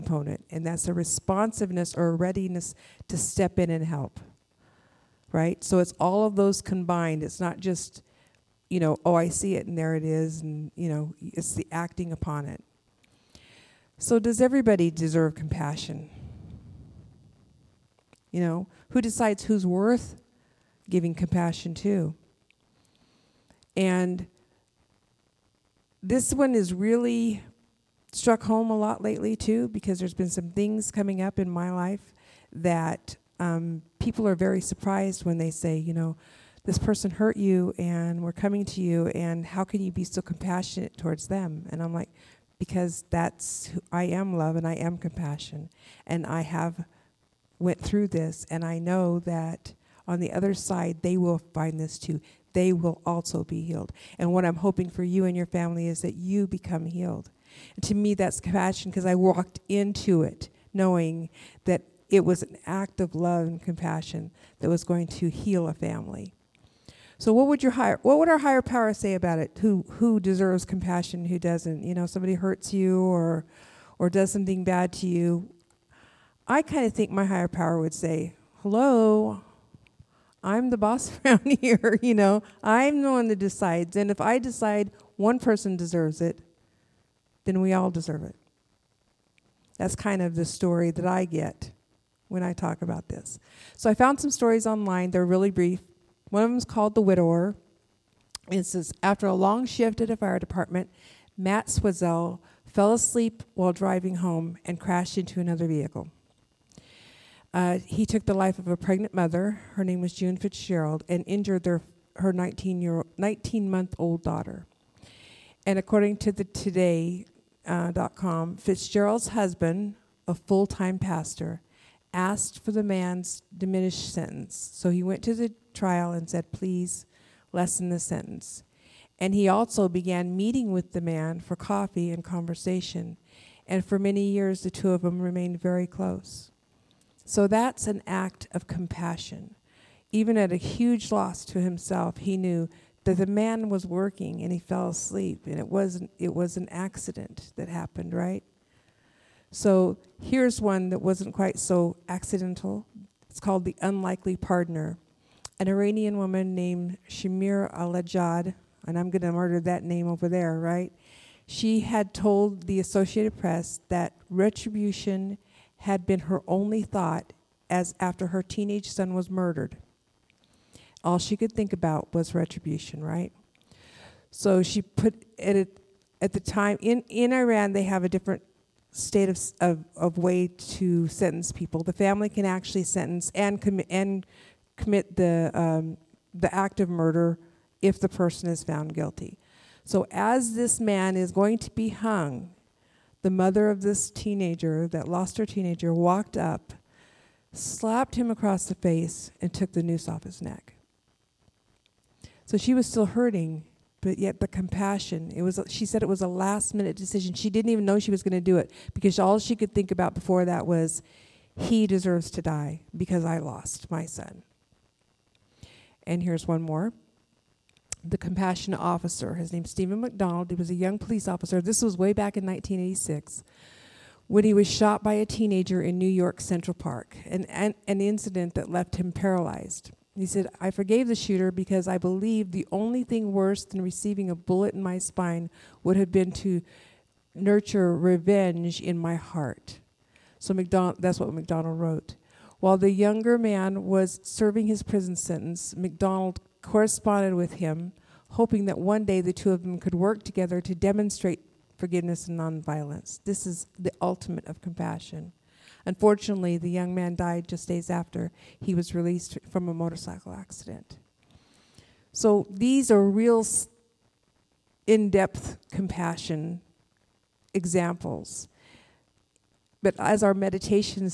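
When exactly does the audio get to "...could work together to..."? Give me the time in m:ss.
4:09.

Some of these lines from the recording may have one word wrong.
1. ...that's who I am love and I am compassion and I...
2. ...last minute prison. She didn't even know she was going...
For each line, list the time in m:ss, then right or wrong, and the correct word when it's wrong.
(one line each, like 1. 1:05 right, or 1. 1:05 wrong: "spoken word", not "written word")
1. 0:43 right
2. 3:26 wrong: "decision", not "prison".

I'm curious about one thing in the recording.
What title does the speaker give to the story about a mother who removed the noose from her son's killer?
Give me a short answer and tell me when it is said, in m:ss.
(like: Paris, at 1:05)
The Unlikely Partner, at 2:33.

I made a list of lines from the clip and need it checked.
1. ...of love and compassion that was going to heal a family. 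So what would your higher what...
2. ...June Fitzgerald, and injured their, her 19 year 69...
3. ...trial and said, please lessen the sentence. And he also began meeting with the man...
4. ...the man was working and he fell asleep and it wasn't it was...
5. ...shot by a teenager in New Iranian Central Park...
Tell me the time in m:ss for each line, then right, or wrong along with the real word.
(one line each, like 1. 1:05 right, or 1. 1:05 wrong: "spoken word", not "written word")
1. 1:03 right
2. 1:50 wrong: "19", not "69"
3. 2:05 right
4. 2:23 right
5. 3:44 wrong: "York", not "Iranian".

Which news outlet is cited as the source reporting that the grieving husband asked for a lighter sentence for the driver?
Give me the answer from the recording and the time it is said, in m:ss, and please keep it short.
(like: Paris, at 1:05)
Today.com, at 1:56.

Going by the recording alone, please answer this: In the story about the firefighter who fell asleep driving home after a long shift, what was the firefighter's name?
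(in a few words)
Matt Swatzell.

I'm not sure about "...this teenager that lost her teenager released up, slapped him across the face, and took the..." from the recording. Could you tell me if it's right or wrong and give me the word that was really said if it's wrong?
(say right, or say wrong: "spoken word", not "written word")
wrong: "walked", not "released".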